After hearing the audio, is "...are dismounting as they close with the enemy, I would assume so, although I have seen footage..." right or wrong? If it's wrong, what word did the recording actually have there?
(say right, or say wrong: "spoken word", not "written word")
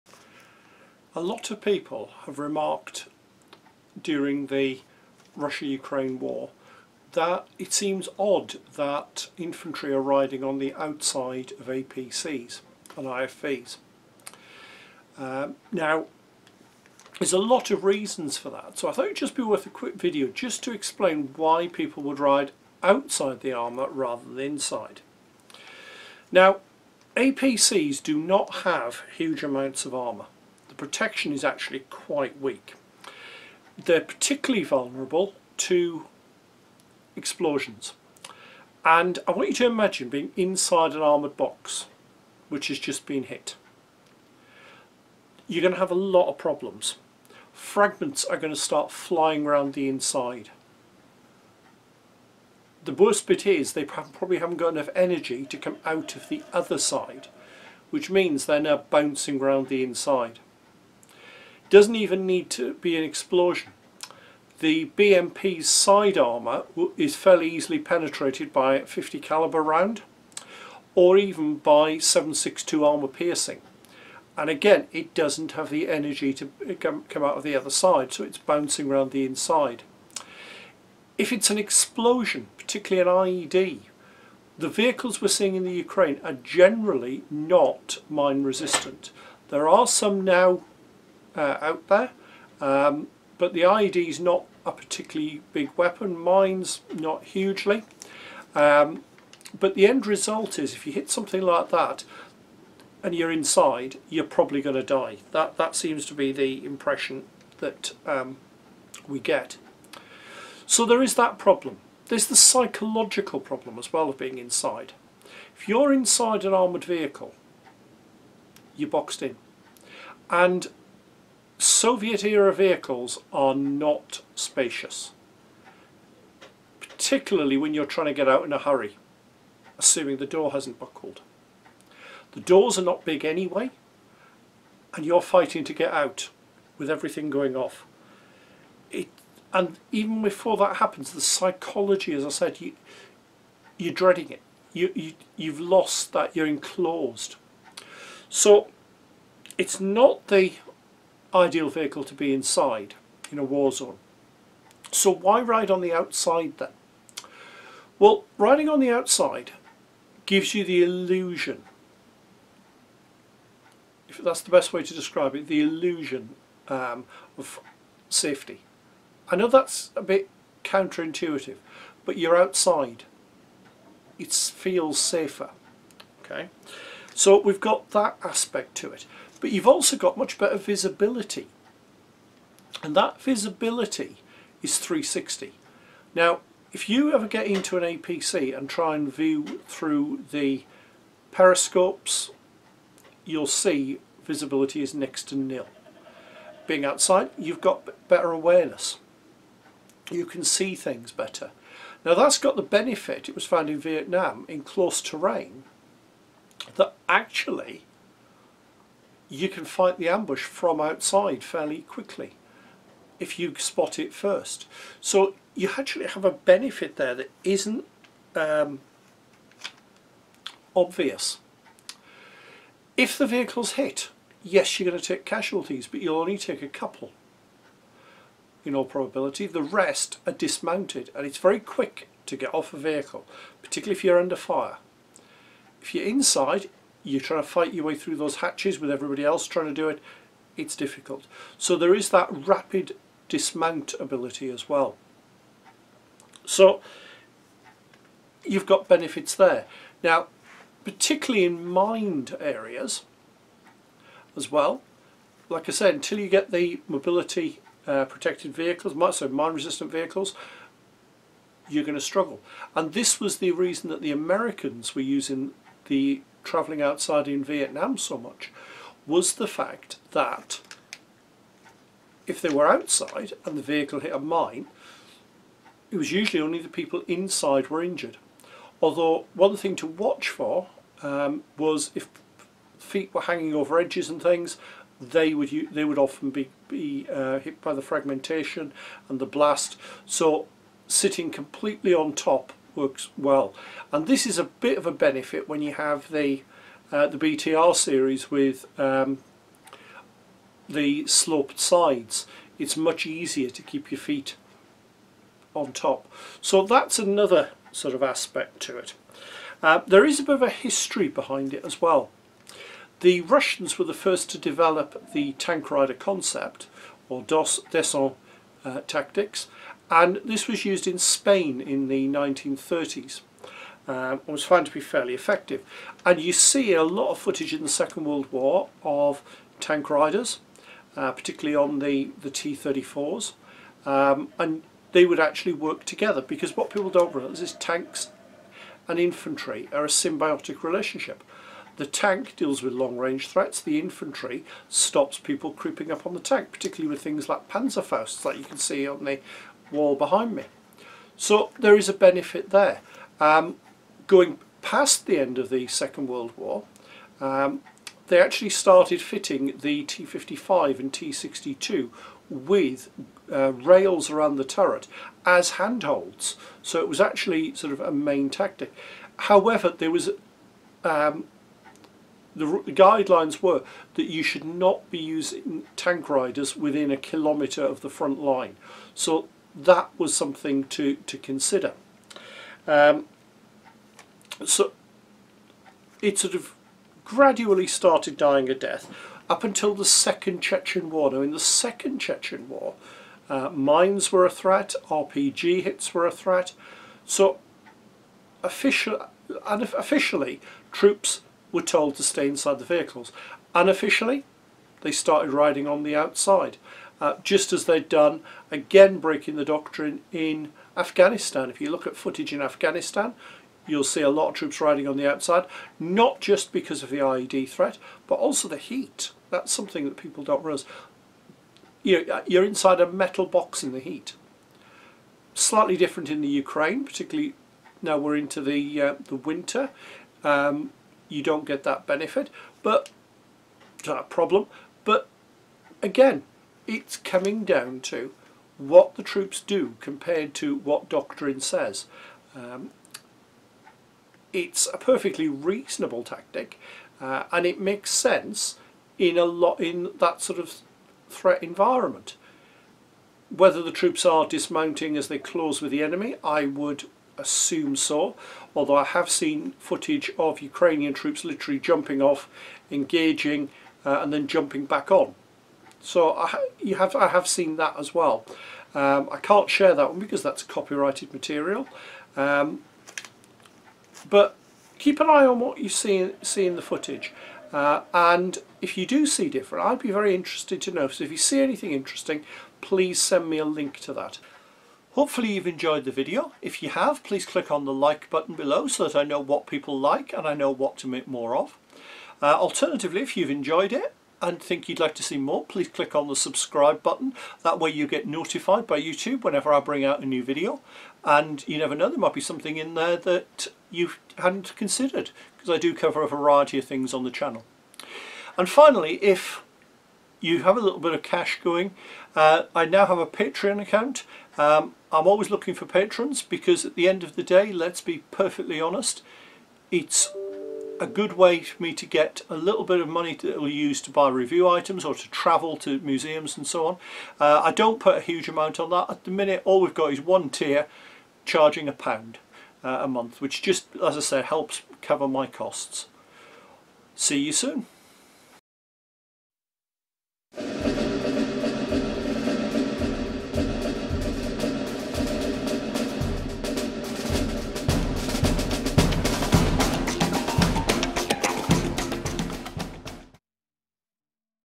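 right.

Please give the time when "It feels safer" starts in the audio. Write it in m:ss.
2:54.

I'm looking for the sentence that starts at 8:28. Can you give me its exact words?
And finally, if you have a little bit of cash going, uh, I now have a Patreon account.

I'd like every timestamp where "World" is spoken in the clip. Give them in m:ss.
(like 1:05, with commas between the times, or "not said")
5:28, 5:56.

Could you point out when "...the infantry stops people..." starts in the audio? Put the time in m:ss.
5:43.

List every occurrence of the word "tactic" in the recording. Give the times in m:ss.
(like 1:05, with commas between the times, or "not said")
5:18, 6:08, 7:26.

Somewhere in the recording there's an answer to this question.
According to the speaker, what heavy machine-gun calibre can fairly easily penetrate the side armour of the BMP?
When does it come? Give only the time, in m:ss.
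1:08.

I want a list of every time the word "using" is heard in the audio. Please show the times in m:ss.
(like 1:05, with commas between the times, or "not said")
4:25, 6:14.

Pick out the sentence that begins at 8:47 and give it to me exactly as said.
Uh, I don't put a huge amount on that.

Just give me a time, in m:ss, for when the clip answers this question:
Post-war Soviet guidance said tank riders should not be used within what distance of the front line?
6:16.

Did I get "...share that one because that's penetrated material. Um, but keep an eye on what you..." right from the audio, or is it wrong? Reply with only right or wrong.
wrong.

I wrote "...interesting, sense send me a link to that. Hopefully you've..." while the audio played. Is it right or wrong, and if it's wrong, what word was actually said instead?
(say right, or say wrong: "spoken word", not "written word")
wrong: "please", not "sense".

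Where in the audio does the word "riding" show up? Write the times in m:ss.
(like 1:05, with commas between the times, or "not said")
0:10, 2:38, 6:45, 6:54.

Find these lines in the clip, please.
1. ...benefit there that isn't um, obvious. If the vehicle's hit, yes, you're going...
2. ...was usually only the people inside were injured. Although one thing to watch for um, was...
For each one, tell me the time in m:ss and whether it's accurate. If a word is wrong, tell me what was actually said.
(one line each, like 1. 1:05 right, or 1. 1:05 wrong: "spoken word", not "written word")
1. 3:36 right
2. 4:35 right.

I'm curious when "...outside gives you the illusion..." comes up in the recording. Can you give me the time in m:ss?
2:38.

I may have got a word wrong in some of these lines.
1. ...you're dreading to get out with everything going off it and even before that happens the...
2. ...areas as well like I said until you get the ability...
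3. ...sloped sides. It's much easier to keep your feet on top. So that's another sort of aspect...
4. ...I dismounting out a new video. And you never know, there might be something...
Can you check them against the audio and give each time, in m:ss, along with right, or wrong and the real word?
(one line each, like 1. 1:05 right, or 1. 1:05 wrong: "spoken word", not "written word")
1. 2:15 wrong: "fighting", not "dreading"
2. 4:12 wrong: "mobility", not "ability"
3. 5:01 right
4. 8:19 wrong: "bring", not "dismounting".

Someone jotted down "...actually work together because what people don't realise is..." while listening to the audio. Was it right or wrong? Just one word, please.
right.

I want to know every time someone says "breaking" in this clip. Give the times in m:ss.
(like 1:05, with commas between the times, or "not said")
6:48.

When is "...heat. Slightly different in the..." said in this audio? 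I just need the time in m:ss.
7:03.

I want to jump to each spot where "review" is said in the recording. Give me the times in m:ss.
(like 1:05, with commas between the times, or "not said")
8:44.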